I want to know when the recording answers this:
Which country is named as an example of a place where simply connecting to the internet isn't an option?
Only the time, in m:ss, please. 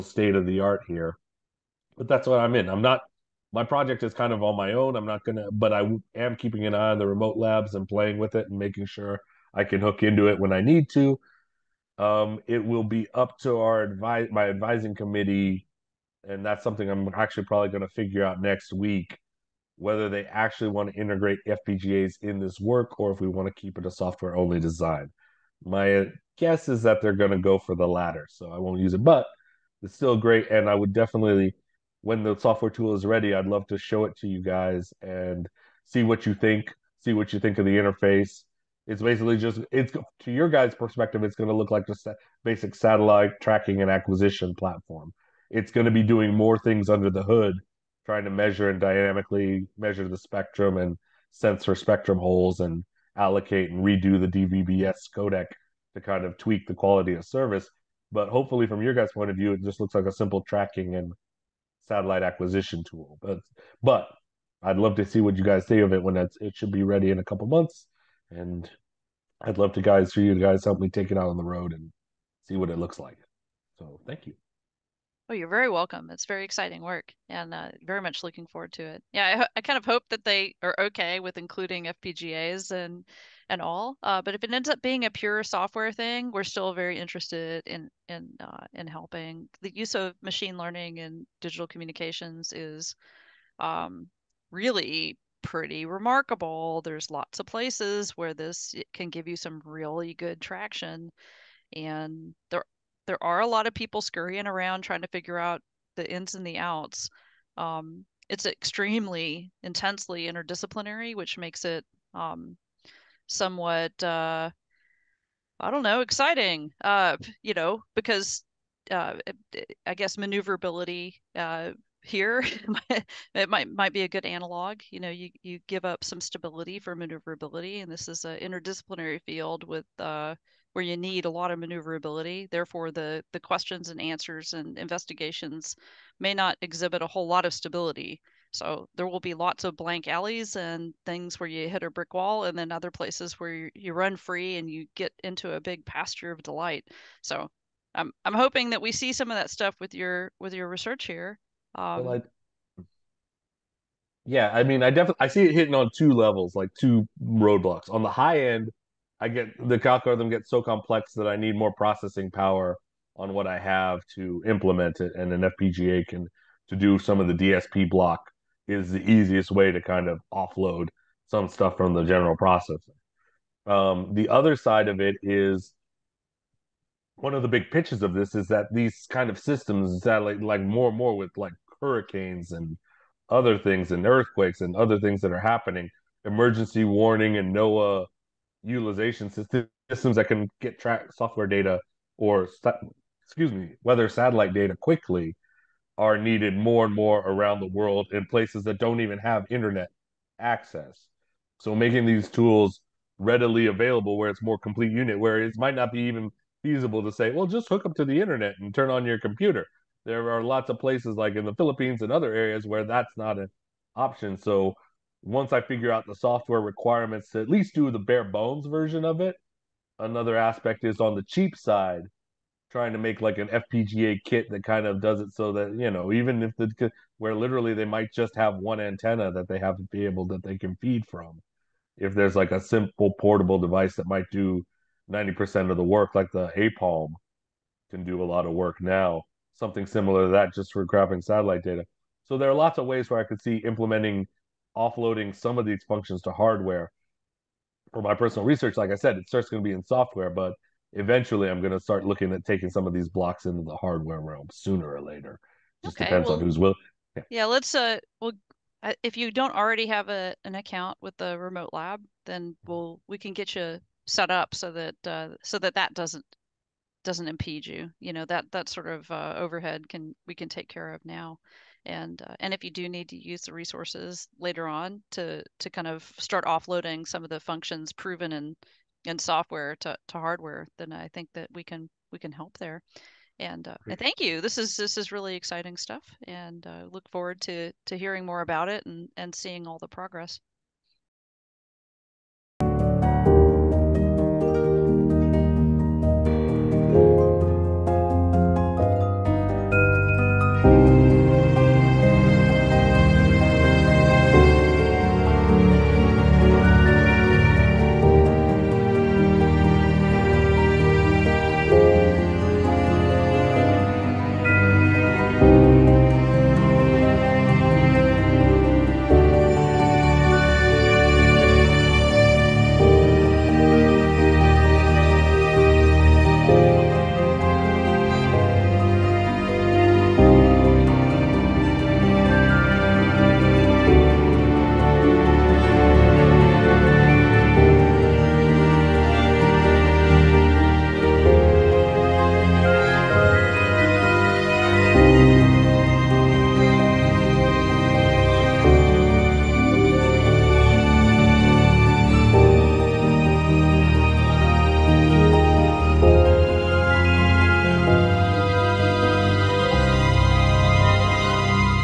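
3:31.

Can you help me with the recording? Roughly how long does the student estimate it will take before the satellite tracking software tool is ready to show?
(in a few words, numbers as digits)
a couple months.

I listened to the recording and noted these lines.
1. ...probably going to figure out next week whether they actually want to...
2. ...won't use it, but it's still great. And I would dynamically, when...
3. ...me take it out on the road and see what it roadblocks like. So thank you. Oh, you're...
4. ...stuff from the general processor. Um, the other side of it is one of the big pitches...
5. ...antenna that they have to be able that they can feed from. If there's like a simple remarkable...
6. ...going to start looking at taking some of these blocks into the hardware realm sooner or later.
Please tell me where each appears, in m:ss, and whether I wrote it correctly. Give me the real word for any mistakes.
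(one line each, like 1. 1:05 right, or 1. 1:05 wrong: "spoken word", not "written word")
1. 0:17 right
2. 0:28 wrong: "definitely", not "dynamically"
3. 1:10 wrong: "looks", not "roadblocks"
4. 2:51 right
5. 3:48 wrong: "portable", not "remarkable"
6. 4:11 right.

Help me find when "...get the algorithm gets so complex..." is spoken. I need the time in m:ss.
2:39.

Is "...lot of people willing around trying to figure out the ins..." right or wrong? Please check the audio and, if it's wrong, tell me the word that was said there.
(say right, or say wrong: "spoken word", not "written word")
wrong: "scurrying", not "willing".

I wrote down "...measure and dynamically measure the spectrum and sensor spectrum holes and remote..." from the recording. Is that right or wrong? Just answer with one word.
wrong.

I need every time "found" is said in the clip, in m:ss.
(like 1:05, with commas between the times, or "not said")
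not said.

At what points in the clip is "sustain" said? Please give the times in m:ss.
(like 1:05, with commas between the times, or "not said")
not said.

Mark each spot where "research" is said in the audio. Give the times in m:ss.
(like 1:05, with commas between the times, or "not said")
2:30, 4:08.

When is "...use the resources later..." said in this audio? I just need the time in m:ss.
4:33.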